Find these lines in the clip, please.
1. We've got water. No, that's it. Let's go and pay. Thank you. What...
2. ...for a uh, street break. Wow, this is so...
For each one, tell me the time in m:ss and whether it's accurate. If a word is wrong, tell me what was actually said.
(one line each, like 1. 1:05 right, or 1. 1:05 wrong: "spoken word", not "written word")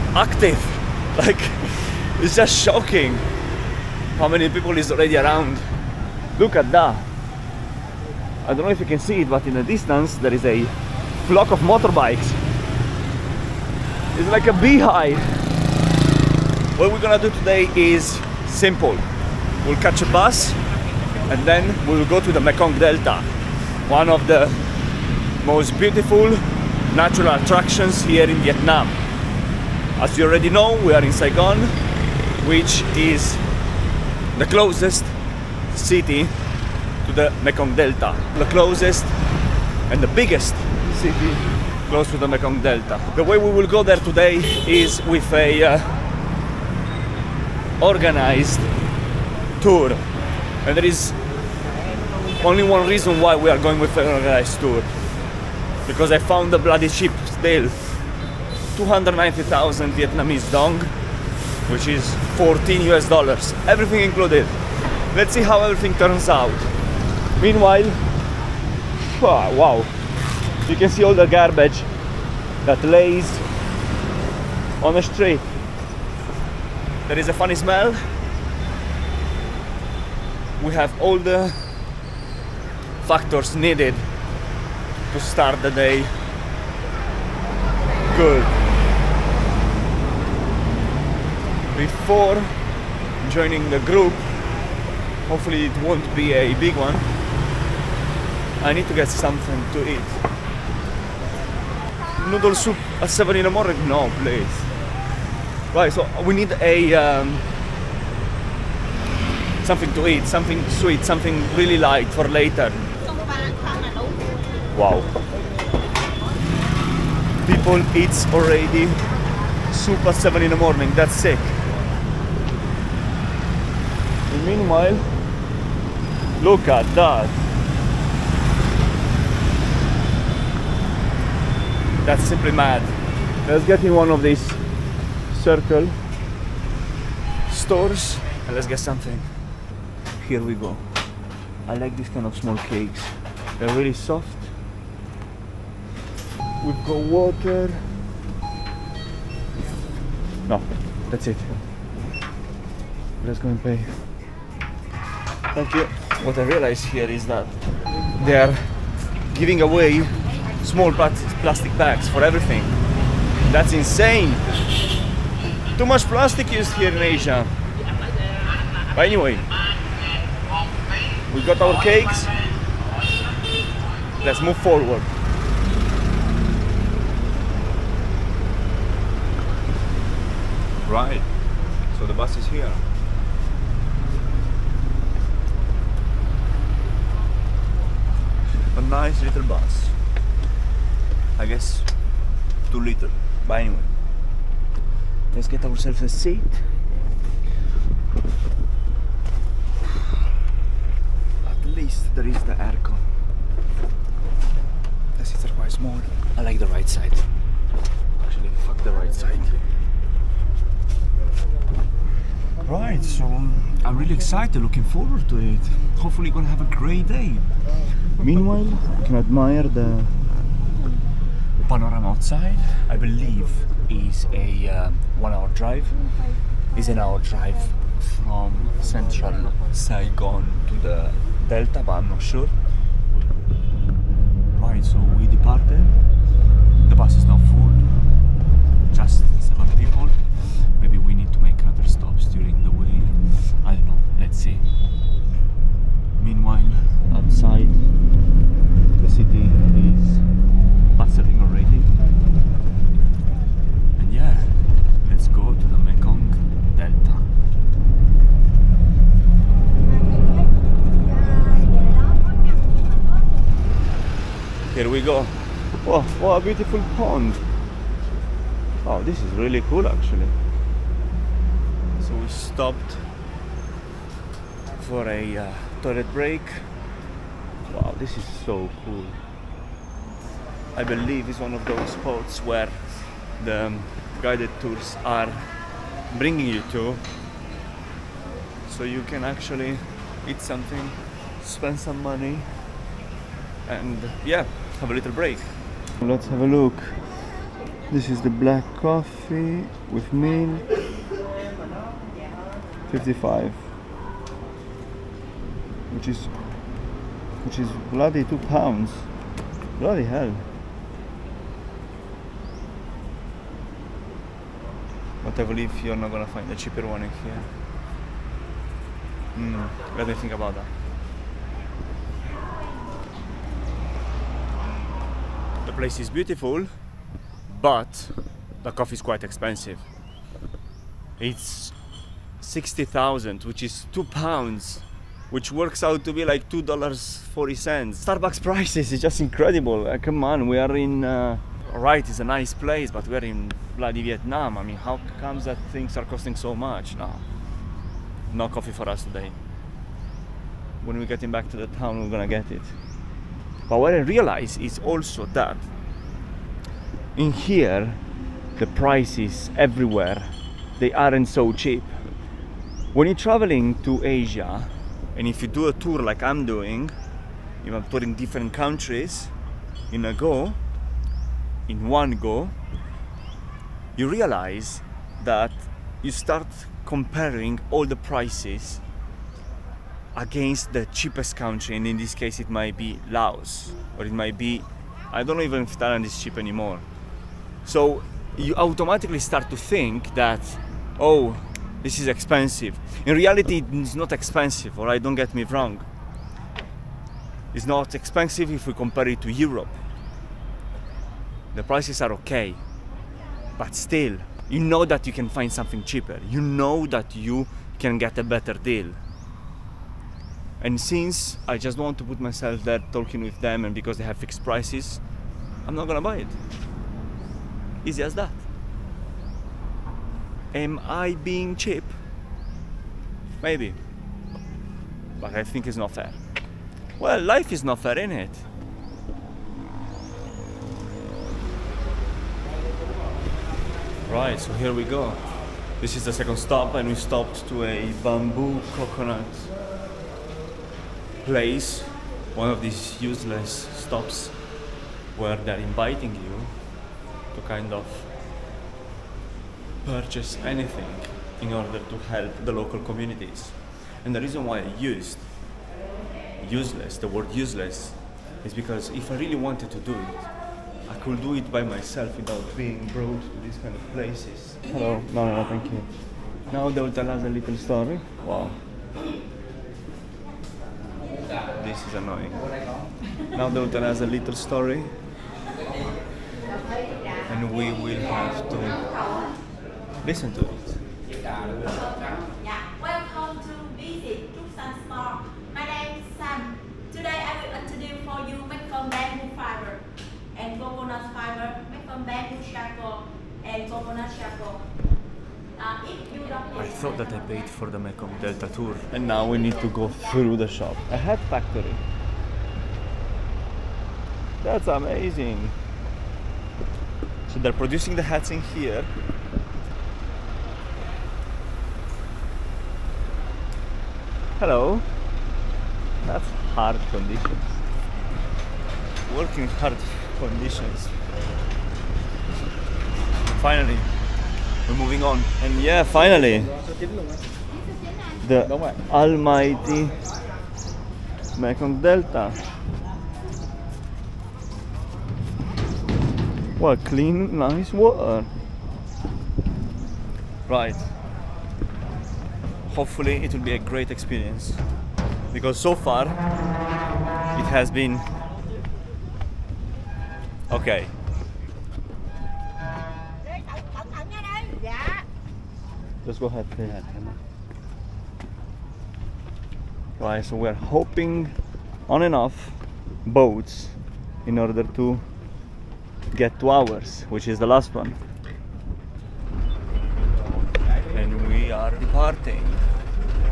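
1. 2:26 right
2. 4:34 wrong: "toilet", not "street".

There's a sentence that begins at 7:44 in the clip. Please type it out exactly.
Hello, no, no, no thank you.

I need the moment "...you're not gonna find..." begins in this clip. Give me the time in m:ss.
5:15.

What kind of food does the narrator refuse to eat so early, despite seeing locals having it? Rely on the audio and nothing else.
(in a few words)
Noodle soup.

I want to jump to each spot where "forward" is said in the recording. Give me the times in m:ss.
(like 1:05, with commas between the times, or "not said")
2:54, 3:34.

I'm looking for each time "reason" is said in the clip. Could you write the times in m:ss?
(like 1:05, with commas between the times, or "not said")
0:52, 7:34.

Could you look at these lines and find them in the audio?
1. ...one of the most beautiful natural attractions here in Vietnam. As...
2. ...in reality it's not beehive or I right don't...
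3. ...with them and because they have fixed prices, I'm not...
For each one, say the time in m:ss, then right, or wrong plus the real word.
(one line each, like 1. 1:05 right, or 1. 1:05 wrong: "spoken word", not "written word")
1. 0:23 right
2. 6:33 wrong: "expensive", not "beehive"
3. 6:53 right.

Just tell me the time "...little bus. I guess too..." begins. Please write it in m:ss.
3:09.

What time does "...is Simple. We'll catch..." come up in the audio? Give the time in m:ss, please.
0:17.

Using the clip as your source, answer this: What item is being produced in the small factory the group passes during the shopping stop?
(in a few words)
Hats.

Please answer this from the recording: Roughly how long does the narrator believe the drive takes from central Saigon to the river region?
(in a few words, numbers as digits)
One hour.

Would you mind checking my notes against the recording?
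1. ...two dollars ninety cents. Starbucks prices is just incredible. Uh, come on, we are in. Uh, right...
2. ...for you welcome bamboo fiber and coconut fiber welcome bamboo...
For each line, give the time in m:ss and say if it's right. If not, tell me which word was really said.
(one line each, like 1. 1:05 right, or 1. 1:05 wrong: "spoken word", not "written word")
1. 5:36 wrong: "forty", not "ninety"
2. 8:08 right.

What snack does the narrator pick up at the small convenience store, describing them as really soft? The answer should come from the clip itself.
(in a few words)
Small cakes.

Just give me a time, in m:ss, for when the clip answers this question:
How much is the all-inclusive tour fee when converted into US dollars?
1:02.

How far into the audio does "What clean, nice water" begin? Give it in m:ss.
8:56.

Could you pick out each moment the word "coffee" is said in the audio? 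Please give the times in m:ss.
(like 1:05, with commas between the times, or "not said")
4:58, 5:28, 5:48.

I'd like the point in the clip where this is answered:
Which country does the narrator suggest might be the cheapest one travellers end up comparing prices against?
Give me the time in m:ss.
6:23.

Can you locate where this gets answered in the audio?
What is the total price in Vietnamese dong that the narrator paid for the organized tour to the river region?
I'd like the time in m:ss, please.
0:58.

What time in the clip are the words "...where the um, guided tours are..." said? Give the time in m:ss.
4:42.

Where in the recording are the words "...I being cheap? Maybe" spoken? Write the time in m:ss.
7:00.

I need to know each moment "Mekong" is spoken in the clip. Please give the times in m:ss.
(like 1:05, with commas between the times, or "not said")
0:22, 0:37, 0:42, 8:17, 8:51.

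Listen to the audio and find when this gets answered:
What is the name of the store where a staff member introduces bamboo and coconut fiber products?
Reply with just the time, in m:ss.
8:04.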